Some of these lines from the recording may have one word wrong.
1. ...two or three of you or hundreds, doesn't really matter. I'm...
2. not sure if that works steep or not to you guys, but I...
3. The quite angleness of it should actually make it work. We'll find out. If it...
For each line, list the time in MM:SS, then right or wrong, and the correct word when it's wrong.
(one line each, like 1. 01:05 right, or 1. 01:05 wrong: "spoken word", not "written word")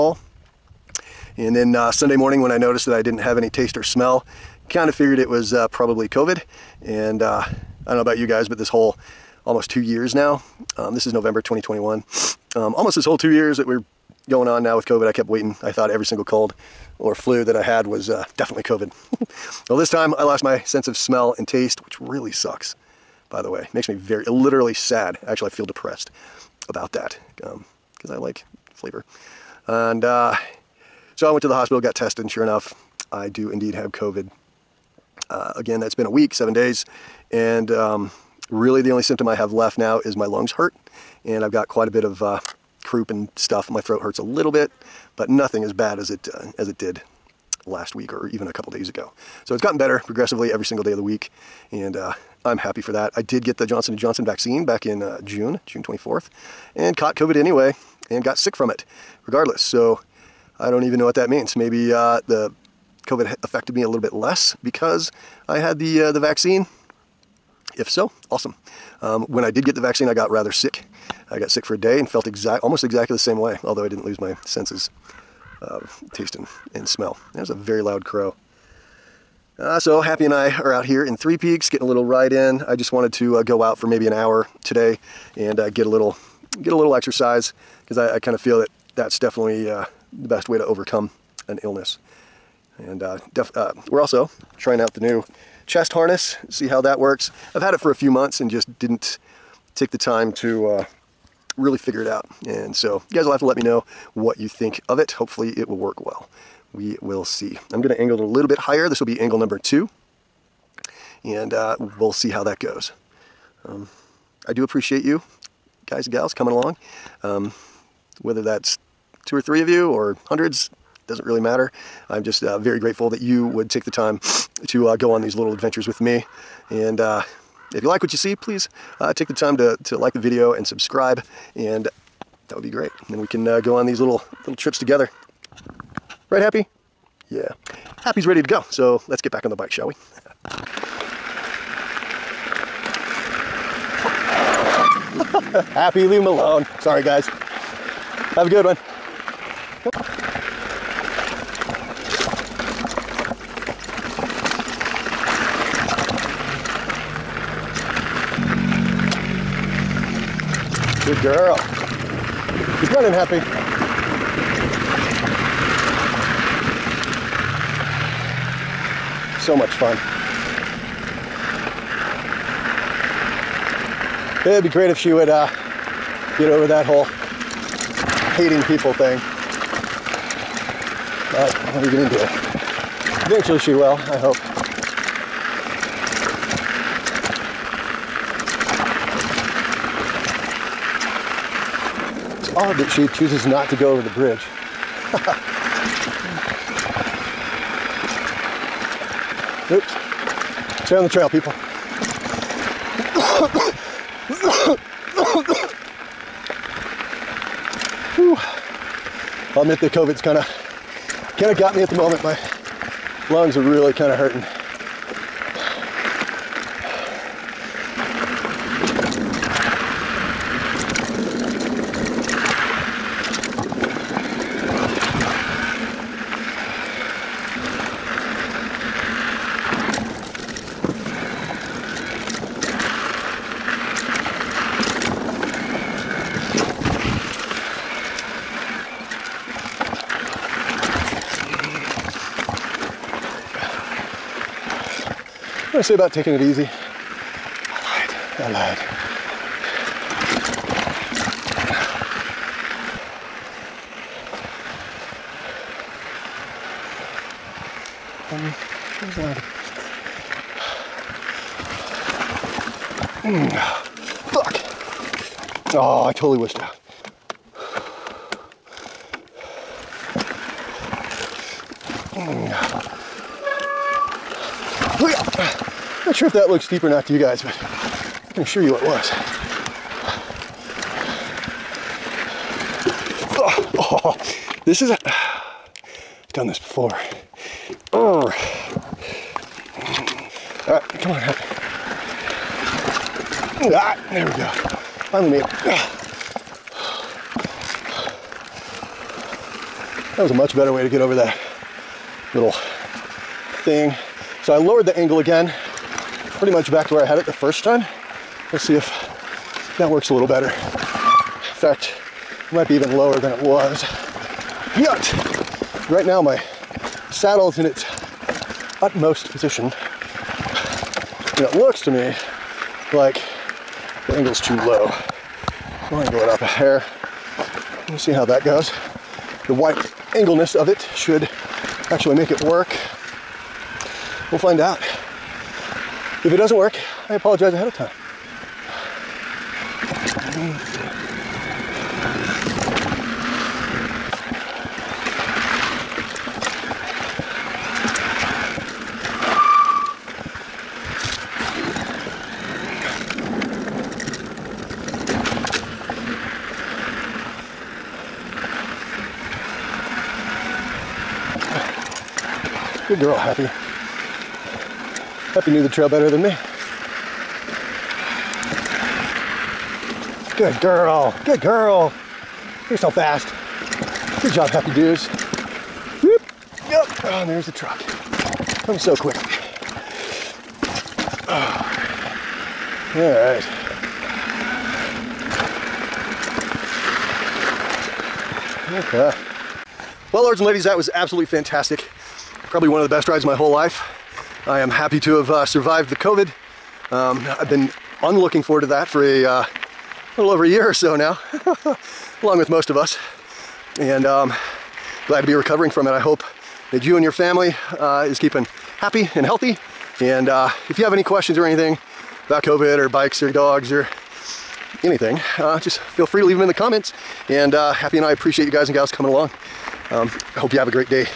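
1. 01:59 right
2. 04:35 wrong: "looks", not "works"
3. 05:29 wrong: "white", not "quite".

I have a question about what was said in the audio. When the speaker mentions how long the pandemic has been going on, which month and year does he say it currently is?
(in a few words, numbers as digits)
November 2021.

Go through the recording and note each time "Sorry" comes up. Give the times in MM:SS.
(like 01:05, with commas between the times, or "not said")
02:26.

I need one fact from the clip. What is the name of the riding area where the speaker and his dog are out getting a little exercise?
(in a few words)
Three Peaks.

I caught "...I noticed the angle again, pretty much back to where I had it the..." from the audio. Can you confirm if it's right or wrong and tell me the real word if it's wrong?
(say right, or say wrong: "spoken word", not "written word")
wrong: "lowered", not "noticed".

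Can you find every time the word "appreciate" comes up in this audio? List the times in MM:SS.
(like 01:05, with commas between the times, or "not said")
01:54, 06:58.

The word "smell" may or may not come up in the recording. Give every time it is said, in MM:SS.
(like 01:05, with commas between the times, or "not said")
00:03, 00:20, 01:16.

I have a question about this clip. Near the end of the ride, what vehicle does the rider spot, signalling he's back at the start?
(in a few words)
The truck.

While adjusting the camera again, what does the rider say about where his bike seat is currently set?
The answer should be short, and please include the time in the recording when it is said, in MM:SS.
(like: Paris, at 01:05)
Its utmost position, at 05:17.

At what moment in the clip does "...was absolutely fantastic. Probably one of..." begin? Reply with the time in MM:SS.
06:30.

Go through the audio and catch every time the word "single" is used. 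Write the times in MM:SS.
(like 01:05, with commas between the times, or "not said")
00:16, 00:50.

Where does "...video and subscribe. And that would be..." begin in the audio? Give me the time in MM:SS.
02:10.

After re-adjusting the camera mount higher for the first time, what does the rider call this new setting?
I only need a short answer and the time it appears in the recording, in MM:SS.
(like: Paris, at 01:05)
Angle number two, at 01:49.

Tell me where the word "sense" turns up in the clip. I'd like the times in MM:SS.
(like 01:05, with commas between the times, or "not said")
00:20, 01:14.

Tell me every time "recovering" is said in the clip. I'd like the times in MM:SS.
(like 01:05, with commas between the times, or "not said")
06:45.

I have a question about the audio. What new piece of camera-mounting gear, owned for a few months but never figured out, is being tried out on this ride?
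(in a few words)
Chest harness.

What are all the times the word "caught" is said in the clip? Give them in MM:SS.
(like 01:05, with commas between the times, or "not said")
00:56.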